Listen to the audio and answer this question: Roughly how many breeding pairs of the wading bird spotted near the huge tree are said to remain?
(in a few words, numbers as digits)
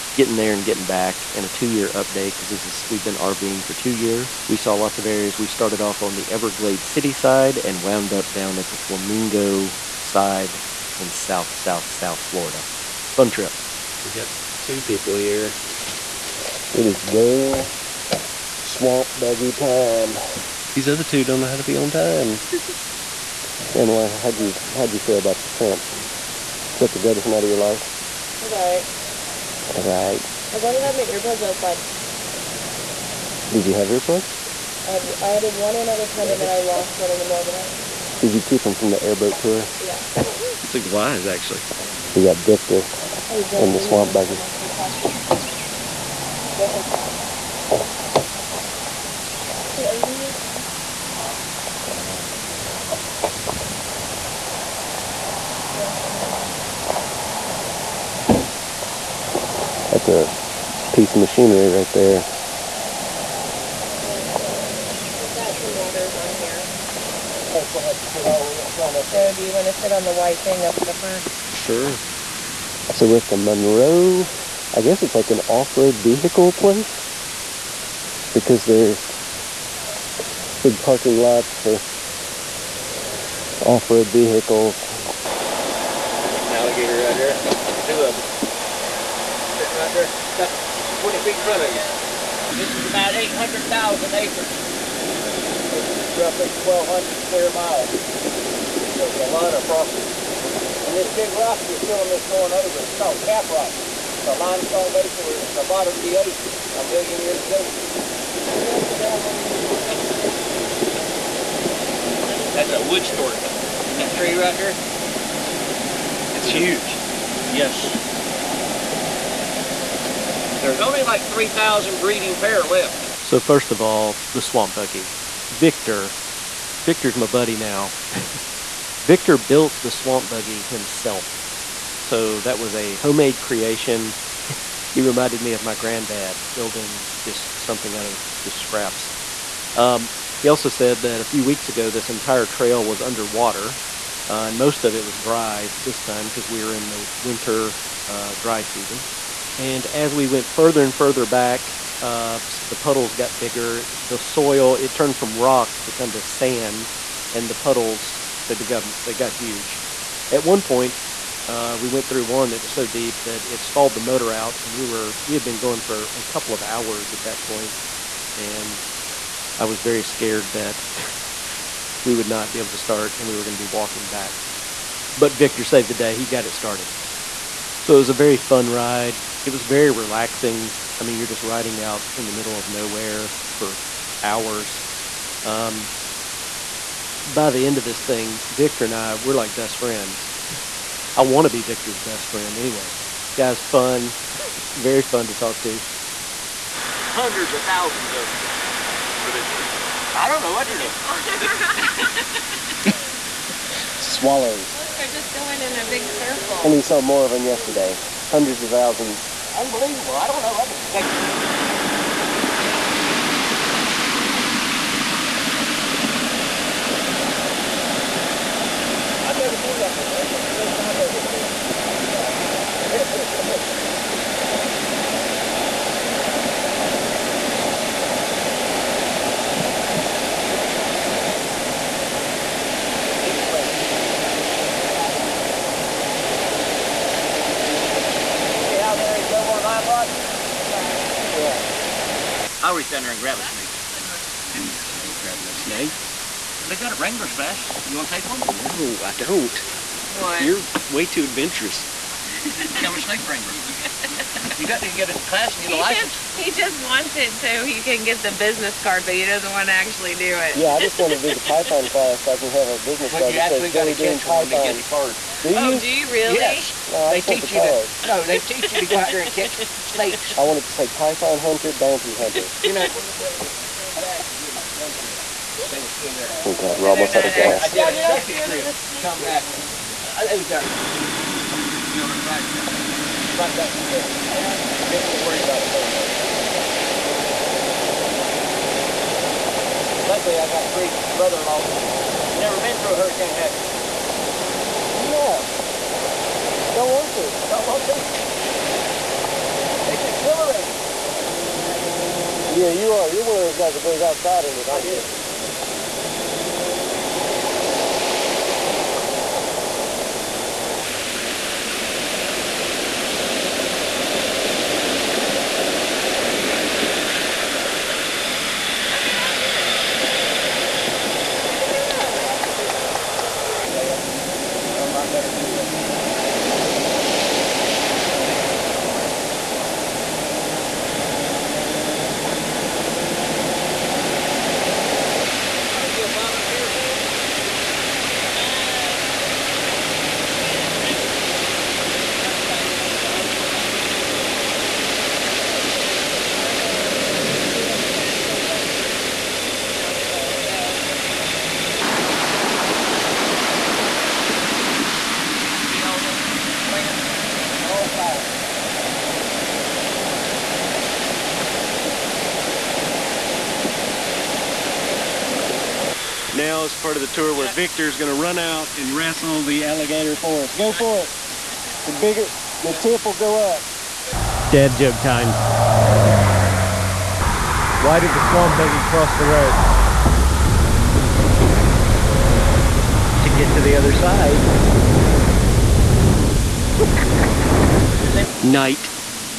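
3,000.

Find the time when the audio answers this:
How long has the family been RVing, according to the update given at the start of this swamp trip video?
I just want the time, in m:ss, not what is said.
0:03.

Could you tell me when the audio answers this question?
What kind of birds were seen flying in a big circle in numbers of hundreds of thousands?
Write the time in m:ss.
3:24.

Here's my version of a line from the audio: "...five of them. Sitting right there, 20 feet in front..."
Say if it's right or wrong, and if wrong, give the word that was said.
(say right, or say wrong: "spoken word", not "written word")
wrong: "two", not "five".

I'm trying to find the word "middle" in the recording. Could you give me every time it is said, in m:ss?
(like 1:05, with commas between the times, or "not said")
0:37, 3:02.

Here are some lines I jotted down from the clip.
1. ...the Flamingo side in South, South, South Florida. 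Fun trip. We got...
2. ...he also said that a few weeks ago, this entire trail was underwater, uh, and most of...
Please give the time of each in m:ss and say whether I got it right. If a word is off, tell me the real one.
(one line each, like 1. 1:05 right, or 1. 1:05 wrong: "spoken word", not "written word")
1. 0:08 right
2. 2:20 right.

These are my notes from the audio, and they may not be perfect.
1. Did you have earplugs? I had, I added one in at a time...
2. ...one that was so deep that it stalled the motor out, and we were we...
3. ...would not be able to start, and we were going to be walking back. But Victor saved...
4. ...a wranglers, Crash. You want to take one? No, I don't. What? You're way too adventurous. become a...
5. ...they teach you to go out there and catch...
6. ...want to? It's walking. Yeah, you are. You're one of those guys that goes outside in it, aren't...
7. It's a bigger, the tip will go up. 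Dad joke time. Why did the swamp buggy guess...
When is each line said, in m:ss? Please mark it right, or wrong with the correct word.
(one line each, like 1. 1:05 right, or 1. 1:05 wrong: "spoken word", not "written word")
1. 0:33 right
2. 2:42 right
3. 2:52 right
4. 4:06 right
5. 4:28 right
6. 4:57 wrong: "exhilarating", not "walking"
7. 6:11 wrong: "cross", not "guess".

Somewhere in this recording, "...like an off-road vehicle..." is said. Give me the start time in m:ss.
1:15.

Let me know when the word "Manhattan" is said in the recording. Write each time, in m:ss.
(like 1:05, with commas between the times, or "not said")
not said.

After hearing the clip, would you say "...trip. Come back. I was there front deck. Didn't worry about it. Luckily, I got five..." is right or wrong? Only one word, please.
wrong.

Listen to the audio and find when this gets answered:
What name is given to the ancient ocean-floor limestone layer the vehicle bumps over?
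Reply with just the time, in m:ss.
1:43.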